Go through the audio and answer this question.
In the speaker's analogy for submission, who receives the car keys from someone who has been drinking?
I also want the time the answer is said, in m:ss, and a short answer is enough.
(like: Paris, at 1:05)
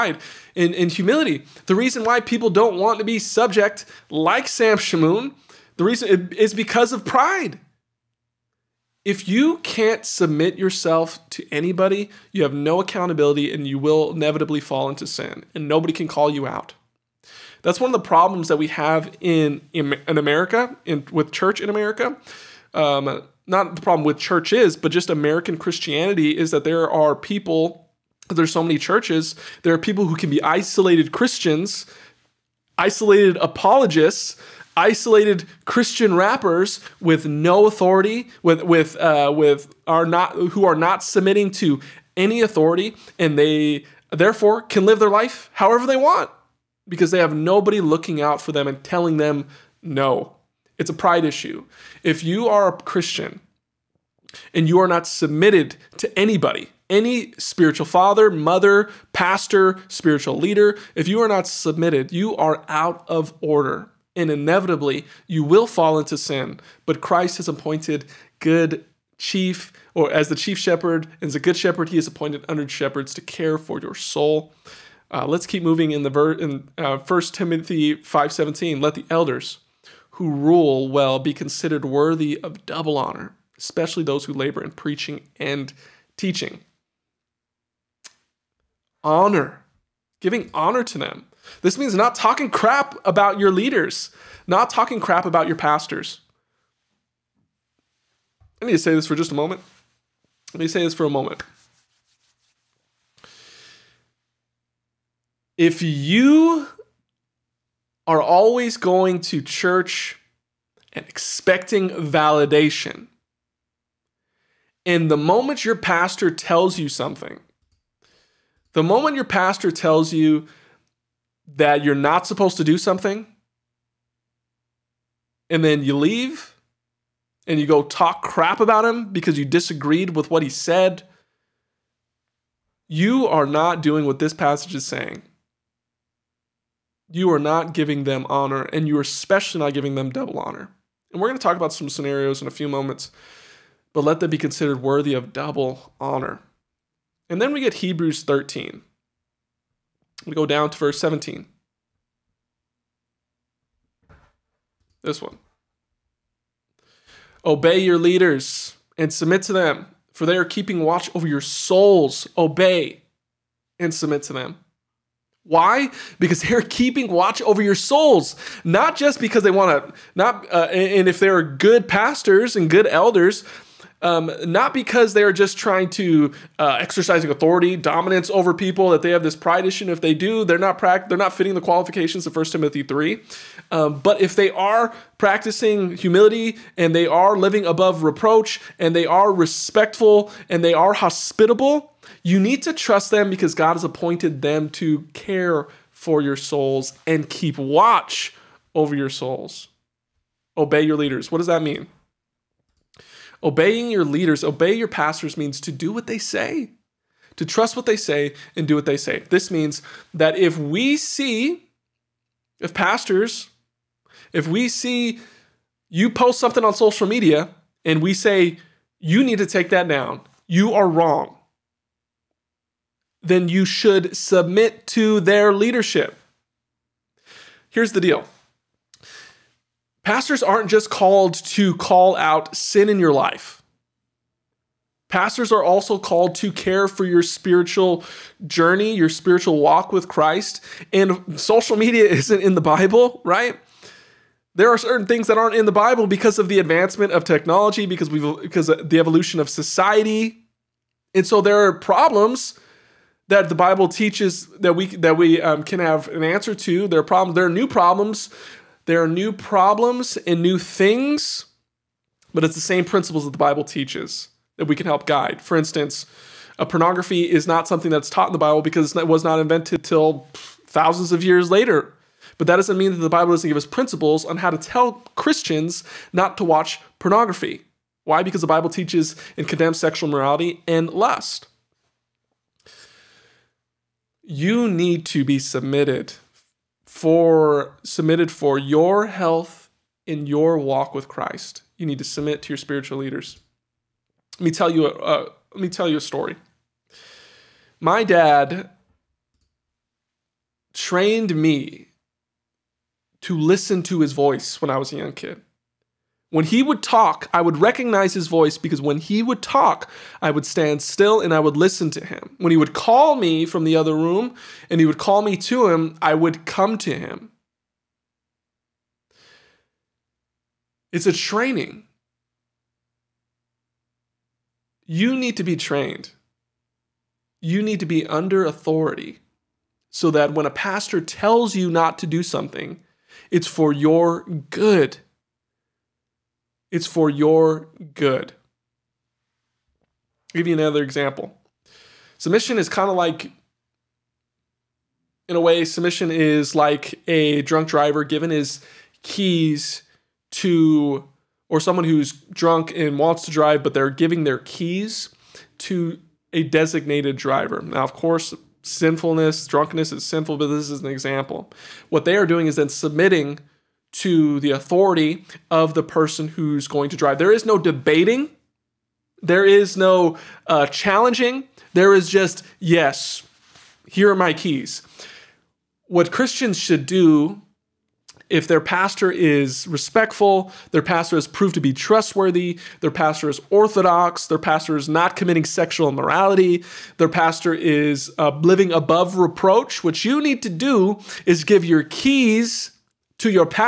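A designated driver, at 5:56.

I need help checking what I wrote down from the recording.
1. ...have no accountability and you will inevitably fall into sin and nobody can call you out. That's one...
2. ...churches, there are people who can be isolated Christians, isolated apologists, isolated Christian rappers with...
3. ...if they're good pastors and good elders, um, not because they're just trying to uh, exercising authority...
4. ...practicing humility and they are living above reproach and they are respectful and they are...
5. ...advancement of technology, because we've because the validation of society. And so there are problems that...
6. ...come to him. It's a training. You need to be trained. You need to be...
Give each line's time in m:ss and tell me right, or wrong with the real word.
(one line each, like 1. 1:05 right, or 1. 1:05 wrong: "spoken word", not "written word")
1. 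0:12 right
2. 0:28 right
3. 2:51 right
4. 3:05 right
5. 4:06 wrong: "evolution", not "validation"
6. 5:16 right.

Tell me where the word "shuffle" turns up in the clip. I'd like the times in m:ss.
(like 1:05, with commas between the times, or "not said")
not said.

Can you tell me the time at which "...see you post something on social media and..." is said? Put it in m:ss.
3:34.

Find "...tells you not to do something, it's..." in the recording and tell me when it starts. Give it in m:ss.
5:31.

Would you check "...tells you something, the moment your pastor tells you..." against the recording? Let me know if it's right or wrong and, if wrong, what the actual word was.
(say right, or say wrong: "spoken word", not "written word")
right.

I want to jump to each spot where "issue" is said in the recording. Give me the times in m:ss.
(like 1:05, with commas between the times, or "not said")
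0:51, 2:59.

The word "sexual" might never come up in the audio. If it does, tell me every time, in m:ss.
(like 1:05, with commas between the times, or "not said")
4:39, 6:25.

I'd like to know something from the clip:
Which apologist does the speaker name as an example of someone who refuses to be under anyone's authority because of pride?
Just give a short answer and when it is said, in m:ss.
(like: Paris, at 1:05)
Sam Shamoun, at 0:04.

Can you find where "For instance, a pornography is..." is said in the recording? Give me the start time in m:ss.
4:25.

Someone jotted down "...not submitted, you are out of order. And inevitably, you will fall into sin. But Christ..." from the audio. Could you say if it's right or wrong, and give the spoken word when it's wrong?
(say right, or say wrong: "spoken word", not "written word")
right.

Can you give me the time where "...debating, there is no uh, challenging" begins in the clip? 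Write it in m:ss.
6:07.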